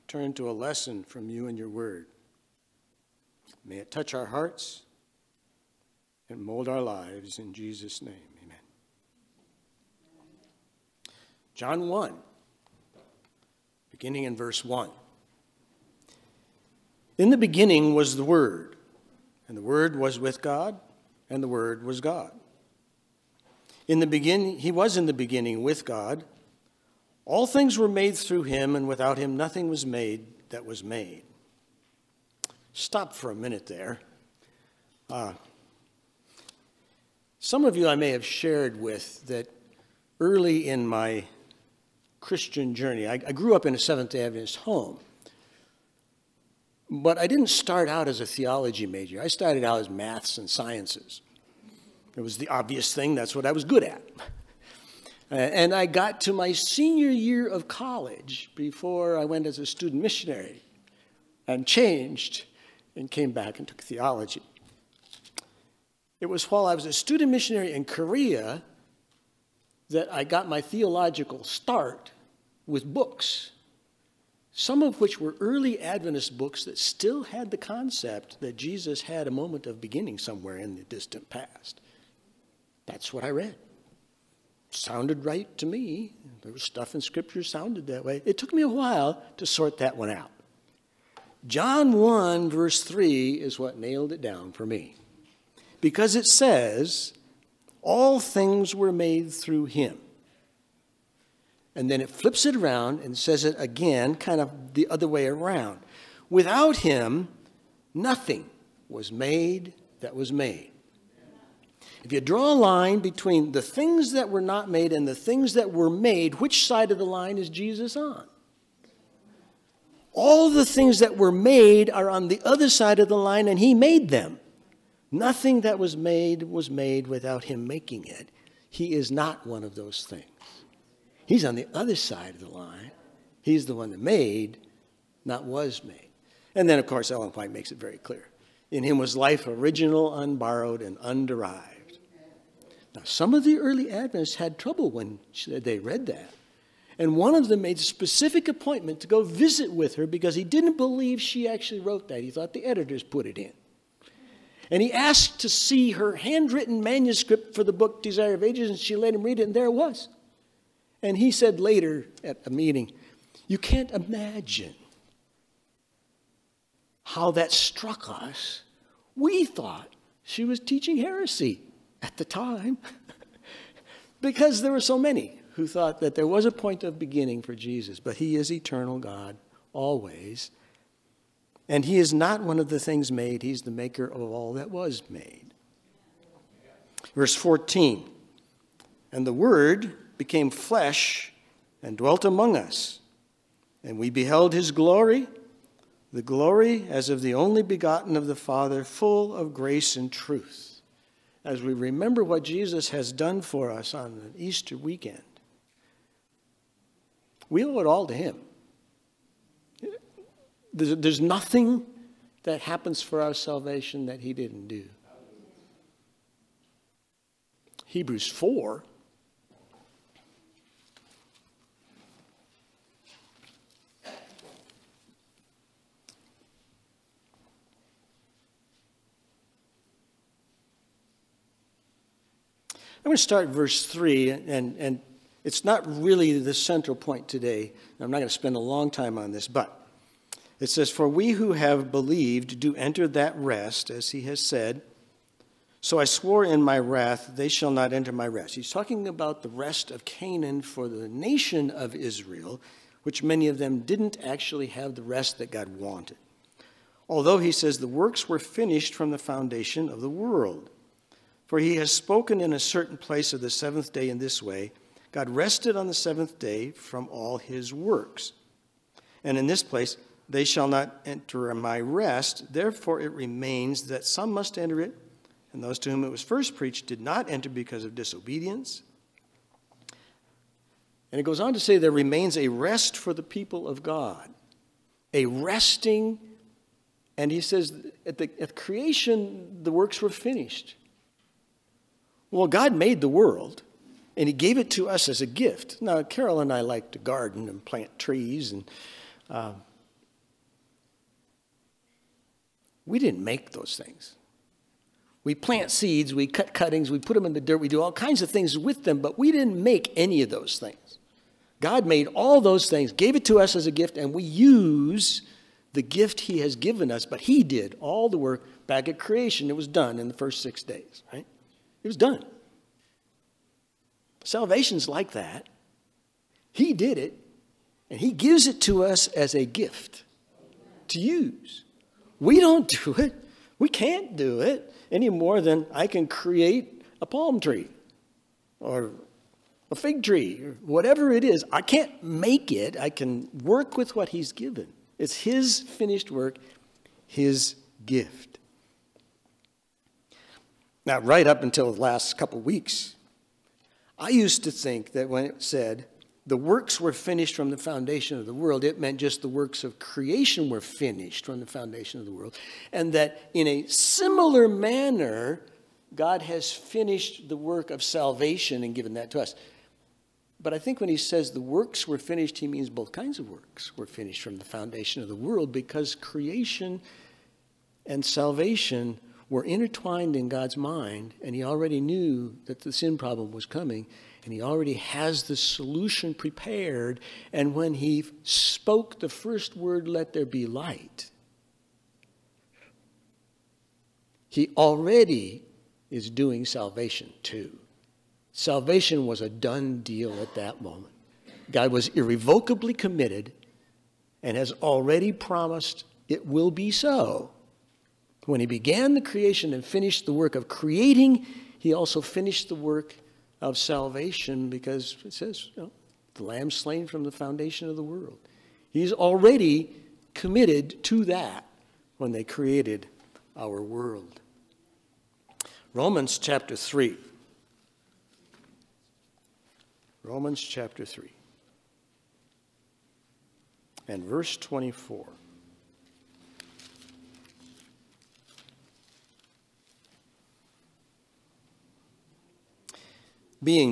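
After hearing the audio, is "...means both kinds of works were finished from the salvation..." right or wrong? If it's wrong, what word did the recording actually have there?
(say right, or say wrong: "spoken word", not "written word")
wrong: "foundation", not "salvation".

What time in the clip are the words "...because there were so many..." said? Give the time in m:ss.
2:54.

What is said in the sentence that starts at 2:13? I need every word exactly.
He's the one that made, not was made.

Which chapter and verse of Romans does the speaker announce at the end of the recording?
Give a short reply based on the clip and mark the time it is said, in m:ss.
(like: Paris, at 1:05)
Romans 3:24, at 7:10.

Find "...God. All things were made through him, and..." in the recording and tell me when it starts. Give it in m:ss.
0:25.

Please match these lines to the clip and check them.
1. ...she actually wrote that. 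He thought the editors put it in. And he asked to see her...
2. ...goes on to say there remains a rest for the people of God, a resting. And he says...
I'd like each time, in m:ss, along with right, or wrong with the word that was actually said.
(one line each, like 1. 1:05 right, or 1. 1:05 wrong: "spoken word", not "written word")
1. 2:31 right
2. 4:41 right.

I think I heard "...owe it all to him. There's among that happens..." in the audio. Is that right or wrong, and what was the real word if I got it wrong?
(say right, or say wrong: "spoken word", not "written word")
wrong: "nothing", not "among".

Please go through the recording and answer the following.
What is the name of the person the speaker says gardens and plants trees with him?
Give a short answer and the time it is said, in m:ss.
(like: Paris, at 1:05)
Carol, at 4:56.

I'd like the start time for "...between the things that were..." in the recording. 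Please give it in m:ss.
1:53.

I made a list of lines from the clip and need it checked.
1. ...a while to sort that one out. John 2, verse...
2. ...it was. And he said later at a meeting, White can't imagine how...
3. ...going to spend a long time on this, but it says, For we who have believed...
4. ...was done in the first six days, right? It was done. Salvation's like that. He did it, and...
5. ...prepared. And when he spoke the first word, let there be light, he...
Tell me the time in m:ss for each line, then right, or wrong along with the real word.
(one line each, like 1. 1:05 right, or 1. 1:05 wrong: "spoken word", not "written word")
1. 1:28 wrong: "1", not "2"
2. 2:39 wrong: "You", not "White"
3. 3:58 right
4. 5:19 right
5. 6:26 right.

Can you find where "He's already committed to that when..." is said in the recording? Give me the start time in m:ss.
6:58.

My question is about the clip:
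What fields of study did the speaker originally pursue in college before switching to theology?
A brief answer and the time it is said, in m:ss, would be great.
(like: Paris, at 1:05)
maths and sciences, at 0:49.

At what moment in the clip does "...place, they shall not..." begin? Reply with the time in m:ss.
4:29.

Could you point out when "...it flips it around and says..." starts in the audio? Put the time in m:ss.
1:42.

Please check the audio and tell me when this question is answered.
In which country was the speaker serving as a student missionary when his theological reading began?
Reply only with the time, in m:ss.
1:07.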